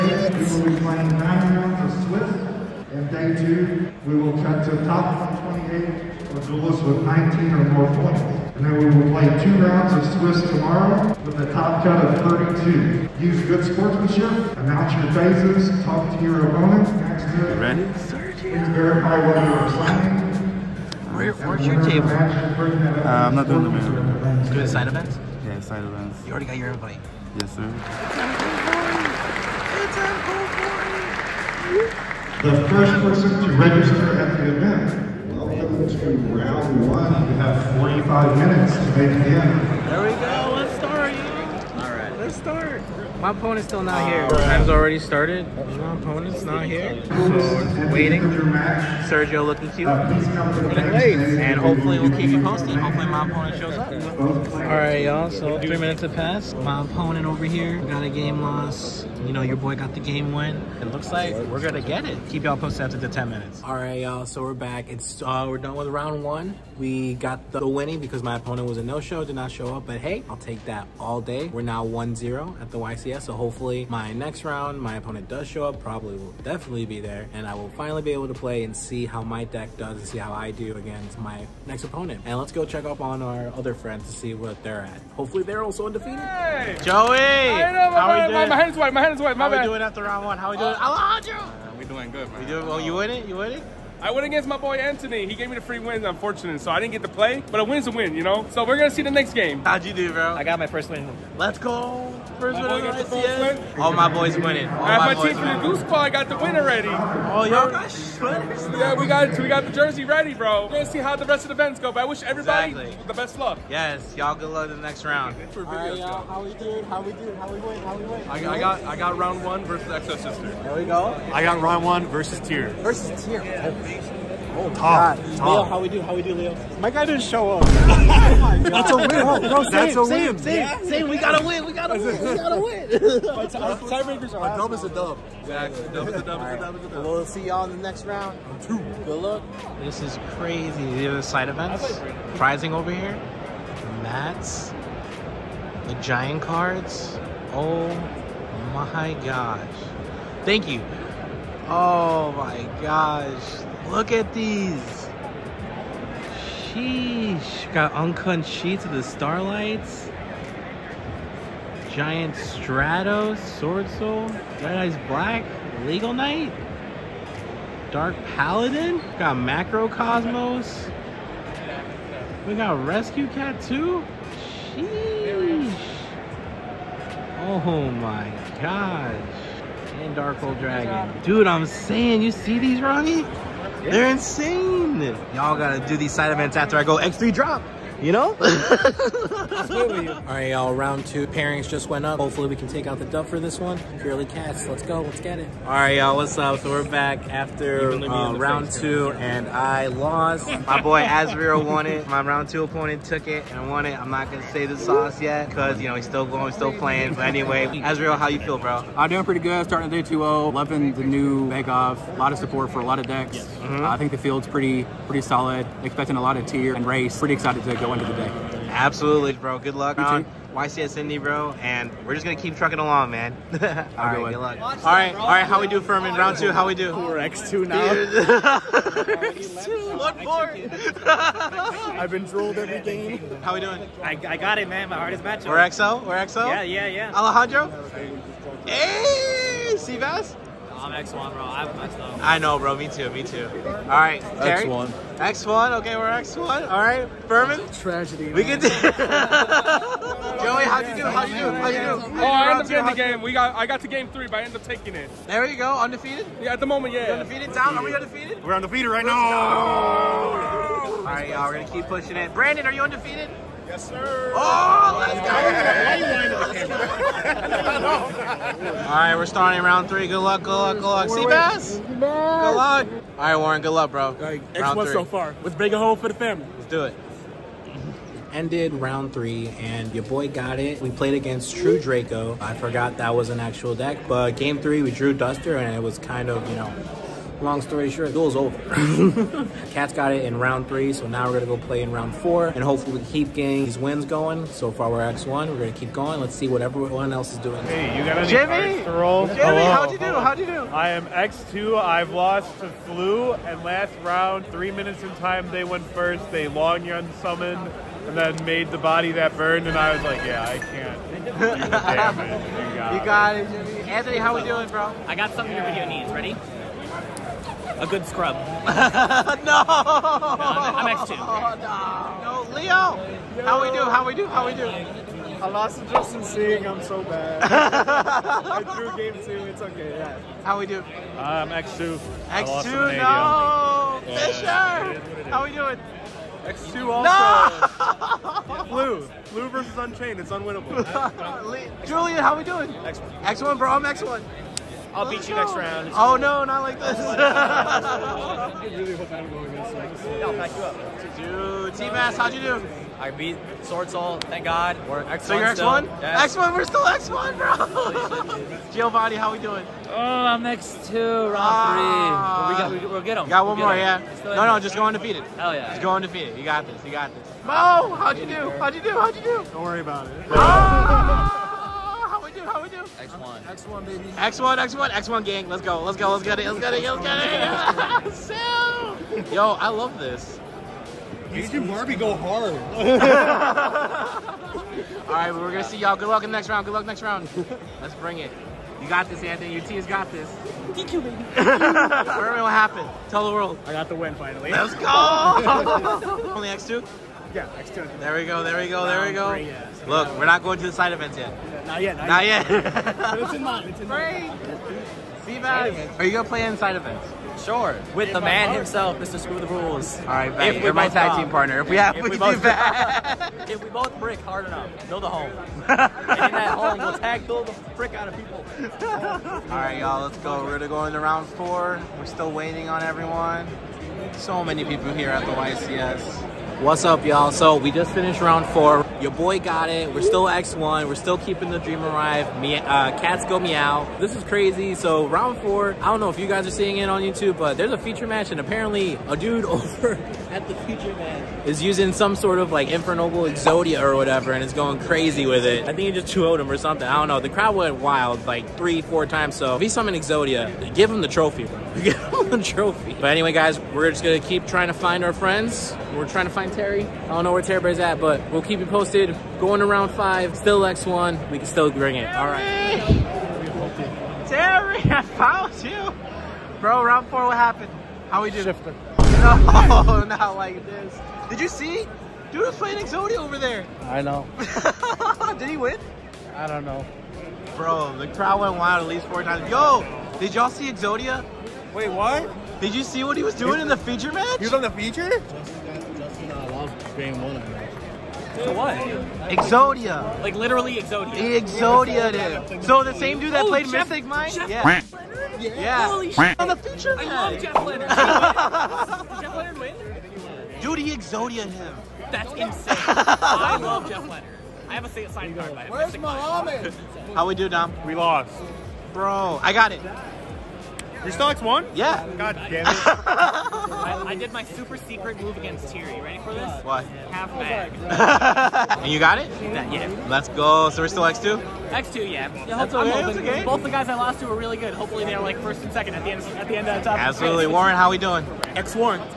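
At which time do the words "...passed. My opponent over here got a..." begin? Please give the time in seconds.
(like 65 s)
56 s.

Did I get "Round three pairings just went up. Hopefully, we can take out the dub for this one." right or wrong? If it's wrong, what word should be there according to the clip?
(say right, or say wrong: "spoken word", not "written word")
wrong: "two", not "three".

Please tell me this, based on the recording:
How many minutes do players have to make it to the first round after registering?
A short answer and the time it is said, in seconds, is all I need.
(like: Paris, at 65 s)
45, at 37 s.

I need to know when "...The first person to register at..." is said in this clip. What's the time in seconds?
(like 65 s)
32 s.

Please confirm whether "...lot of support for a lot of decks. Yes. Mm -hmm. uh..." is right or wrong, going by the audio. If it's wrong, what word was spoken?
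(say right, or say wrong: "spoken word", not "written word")
right.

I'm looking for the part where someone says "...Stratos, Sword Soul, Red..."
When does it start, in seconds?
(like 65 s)
162 s.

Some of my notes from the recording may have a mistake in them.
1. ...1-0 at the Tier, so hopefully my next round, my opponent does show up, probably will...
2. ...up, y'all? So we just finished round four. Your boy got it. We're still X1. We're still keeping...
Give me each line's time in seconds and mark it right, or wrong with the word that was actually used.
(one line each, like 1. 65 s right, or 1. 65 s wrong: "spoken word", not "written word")
1. 71 s wrong: "YCS", not "Tier"
2. 426 s right.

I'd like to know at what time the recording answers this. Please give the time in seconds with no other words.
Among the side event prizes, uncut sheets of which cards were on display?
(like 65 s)
159 s.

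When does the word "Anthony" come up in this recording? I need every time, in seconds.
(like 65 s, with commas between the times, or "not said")
94 s, 313 s, 389 s.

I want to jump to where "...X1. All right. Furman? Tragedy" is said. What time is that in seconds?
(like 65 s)
246 s.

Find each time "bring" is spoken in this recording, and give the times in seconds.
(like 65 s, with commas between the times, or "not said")
387 s, 461 s.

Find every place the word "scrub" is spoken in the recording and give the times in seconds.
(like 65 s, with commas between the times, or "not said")
318 s.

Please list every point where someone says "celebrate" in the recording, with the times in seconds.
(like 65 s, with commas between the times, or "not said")
not said.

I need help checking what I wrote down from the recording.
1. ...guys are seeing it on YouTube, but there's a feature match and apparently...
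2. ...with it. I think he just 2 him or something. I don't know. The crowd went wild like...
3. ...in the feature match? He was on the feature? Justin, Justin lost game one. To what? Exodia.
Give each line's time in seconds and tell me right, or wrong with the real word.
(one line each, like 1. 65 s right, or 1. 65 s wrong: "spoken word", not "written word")
1. 436 s right
2. 445 s right
3. 483 s right.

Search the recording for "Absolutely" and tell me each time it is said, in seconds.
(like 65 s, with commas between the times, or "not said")
218 s, 526 s.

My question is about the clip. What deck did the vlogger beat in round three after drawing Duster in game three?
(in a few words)
True Draco.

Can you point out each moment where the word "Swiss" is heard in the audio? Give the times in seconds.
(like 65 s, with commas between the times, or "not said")
2 s, 10 s.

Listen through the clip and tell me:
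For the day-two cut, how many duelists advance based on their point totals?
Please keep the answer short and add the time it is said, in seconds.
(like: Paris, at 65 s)
128, at 4 s.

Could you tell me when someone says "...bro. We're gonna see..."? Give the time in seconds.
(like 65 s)
110 s.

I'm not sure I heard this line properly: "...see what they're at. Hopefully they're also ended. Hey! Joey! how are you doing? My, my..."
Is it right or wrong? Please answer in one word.
wrong.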